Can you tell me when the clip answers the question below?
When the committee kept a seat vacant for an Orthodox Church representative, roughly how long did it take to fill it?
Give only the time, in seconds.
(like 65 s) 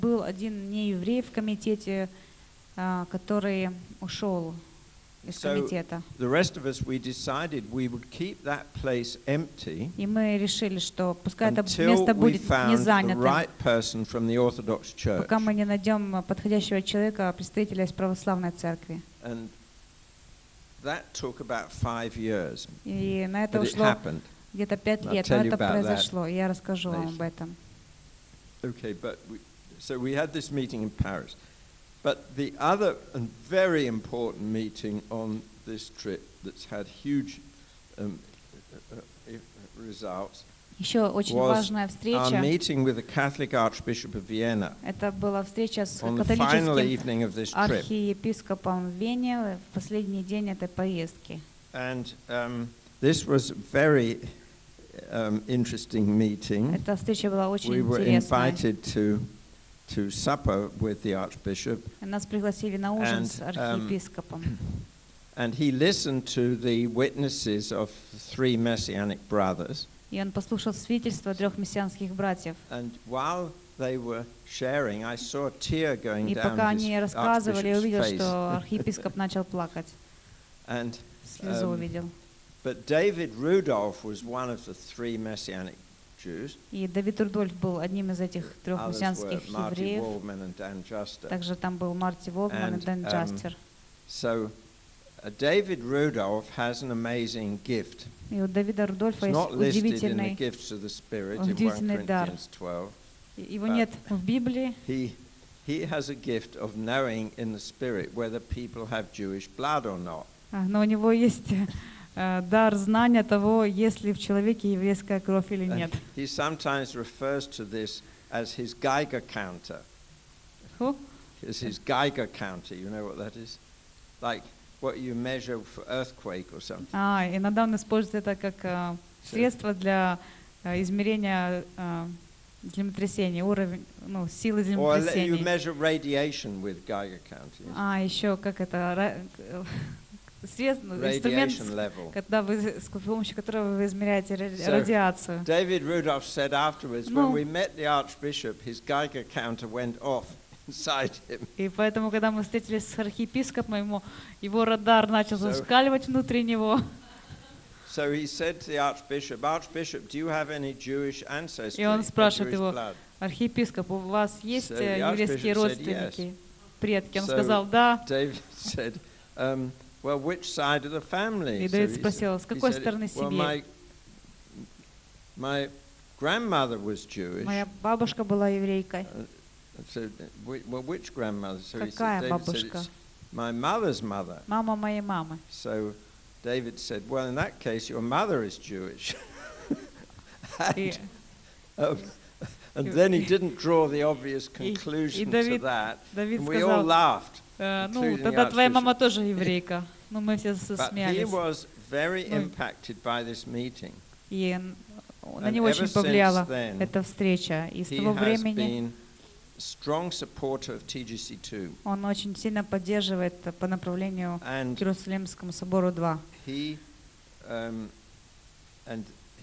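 21 s.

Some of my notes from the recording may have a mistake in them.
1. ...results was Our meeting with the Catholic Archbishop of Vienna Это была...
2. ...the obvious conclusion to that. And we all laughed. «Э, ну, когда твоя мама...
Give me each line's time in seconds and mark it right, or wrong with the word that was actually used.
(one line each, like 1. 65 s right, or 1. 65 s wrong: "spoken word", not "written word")
1. 39 s right
2. 193 s wrong: "тогда", not "когда".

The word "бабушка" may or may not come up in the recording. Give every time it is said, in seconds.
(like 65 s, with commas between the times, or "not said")
177 s, 182 s.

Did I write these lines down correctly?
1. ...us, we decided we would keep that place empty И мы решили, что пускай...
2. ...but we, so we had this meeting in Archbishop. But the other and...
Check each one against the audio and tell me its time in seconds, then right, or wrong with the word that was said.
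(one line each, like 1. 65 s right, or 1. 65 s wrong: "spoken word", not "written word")
1. 6 s right
2. 28 s wrong: "Paris", not "Archbishop".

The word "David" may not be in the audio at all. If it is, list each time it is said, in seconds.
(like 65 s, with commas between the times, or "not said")
82 s, 95 s, 145 s, 168 s, 186 s.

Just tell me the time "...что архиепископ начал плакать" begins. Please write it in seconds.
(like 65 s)
78 s.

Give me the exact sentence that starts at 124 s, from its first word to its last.
Like what you measure for earthquake or something.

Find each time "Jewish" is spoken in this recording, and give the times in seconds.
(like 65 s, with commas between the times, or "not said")
109 s, 160 s, 177 s, 188 s.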